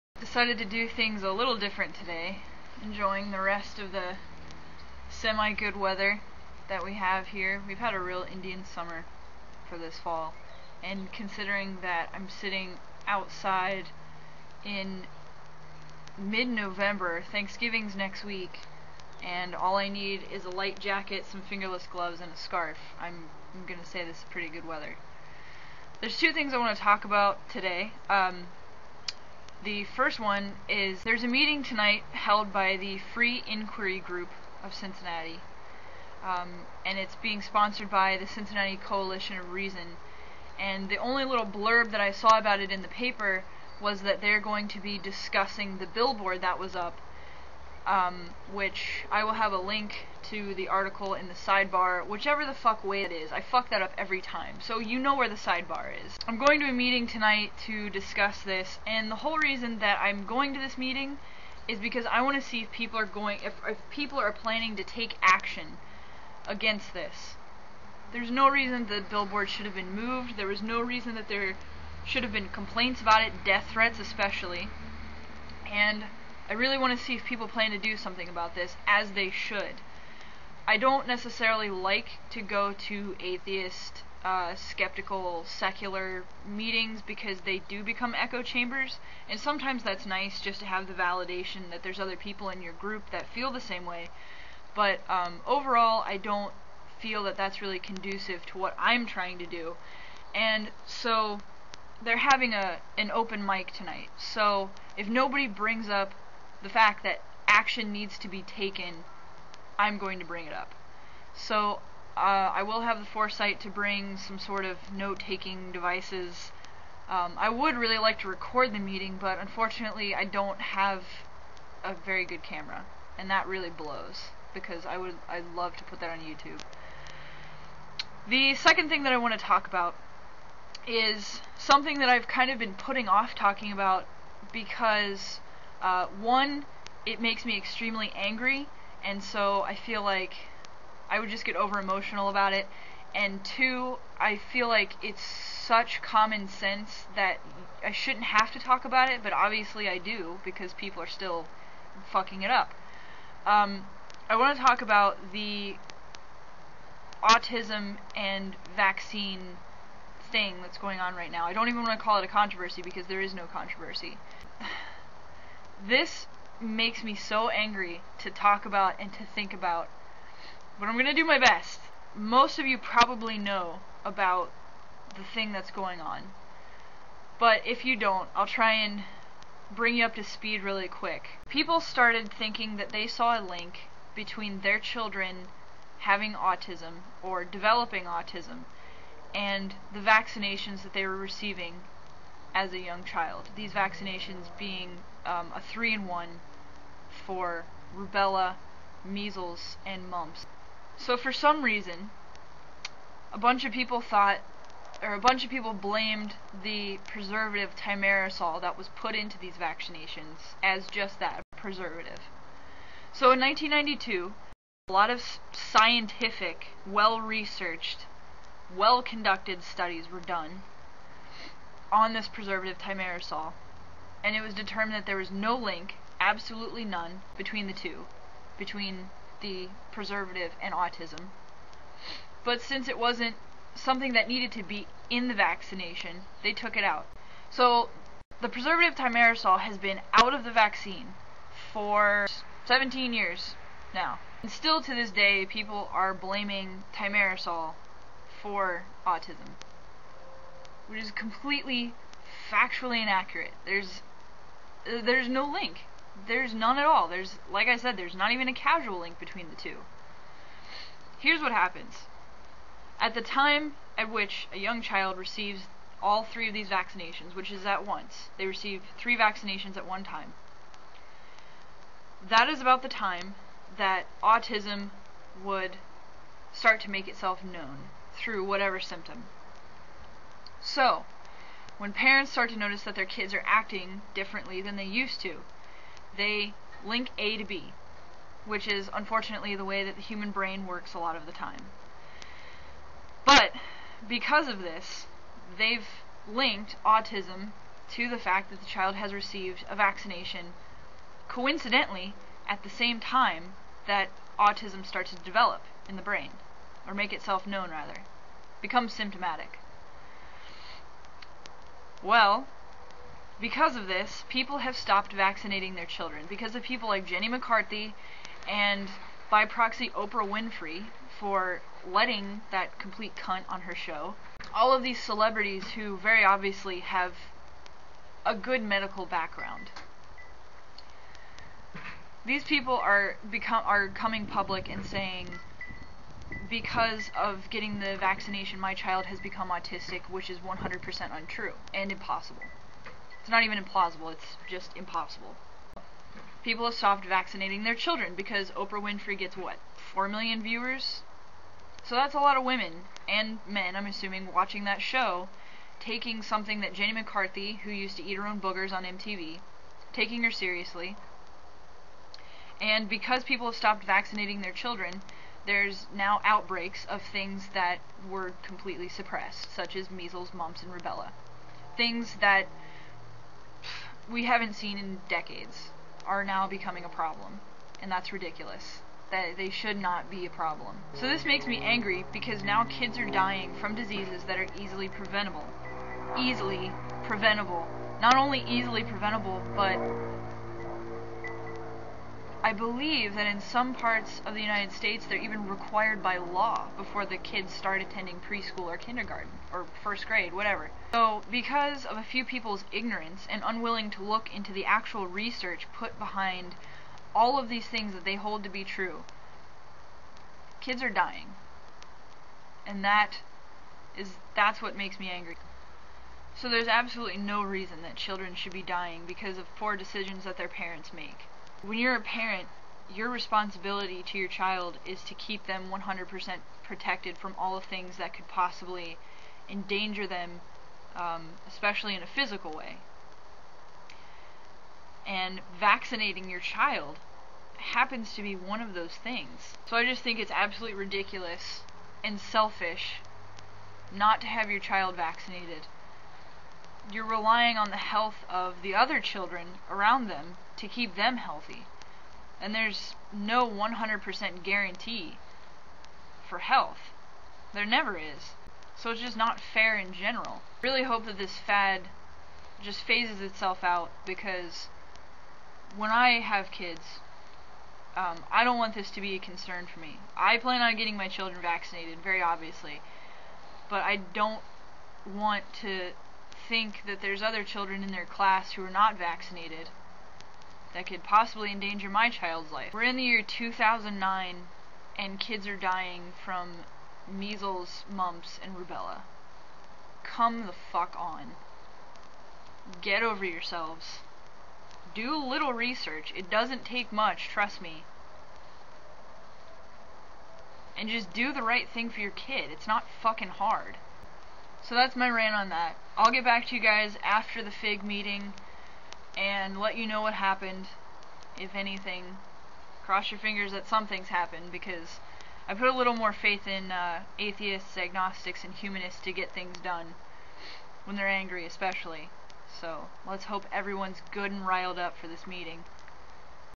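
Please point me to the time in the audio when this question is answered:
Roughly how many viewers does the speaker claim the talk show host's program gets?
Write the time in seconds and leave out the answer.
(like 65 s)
349 s.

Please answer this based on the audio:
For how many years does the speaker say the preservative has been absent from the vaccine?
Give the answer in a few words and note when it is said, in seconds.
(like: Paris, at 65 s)
17, at 242 s.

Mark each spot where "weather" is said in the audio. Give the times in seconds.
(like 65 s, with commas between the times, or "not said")
5 s, 24 s.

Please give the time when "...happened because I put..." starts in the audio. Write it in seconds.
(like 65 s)
514 s.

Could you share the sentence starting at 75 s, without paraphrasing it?
And I really want to see if people plan to do something about this, as they should.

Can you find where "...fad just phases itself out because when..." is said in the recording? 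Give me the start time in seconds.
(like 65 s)
461 s.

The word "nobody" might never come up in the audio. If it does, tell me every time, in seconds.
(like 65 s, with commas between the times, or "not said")
105 s.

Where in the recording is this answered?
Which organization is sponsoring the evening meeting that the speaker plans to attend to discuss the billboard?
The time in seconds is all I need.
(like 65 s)
38 s.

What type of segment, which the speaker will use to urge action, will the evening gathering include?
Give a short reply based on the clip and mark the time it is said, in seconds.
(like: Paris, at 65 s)
open mic, at 103 s.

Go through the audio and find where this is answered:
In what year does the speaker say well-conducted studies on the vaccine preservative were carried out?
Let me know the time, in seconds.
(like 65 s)
213 s.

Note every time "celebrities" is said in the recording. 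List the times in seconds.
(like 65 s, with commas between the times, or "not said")
325 s.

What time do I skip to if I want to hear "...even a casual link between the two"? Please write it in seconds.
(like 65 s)
258 s.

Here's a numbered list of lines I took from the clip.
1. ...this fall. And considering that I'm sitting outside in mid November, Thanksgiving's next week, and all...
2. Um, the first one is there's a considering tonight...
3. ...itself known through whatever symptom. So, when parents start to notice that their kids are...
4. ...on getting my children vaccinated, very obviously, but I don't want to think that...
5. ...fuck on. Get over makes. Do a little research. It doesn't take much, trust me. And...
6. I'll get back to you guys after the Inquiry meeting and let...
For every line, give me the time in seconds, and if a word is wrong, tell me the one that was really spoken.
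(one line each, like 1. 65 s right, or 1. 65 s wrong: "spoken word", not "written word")
1. 9 s right
2. 28 s wrong: "meeting", not "considering"
3. 277 s right
4. 470 s right
5. 490 s wrong: "yourselves", not "makes"
6. 505 s wrong: "FIG", not "Inquiry".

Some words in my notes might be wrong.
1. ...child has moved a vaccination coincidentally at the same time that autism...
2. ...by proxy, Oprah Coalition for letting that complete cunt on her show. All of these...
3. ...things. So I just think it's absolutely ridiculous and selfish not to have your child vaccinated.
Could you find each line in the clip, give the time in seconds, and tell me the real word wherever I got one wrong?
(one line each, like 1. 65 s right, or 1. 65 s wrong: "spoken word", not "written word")
1. 298 s wrong: "received", not "moved"
2. 319 s wrong: "Winfrey", not "Coalition"
3. 439 s right.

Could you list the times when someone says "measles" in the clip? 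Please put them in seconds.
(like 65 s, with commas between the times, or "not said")
199 s, 369 s, 487 s.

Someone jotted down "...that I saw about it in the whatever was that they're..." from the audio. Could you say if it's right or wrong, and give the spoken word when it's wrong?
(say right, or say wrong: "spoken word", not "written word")
wrong: "paper", not "whatever".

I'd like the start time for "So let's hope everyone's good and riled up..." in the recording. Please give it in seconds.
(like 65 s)
522 s.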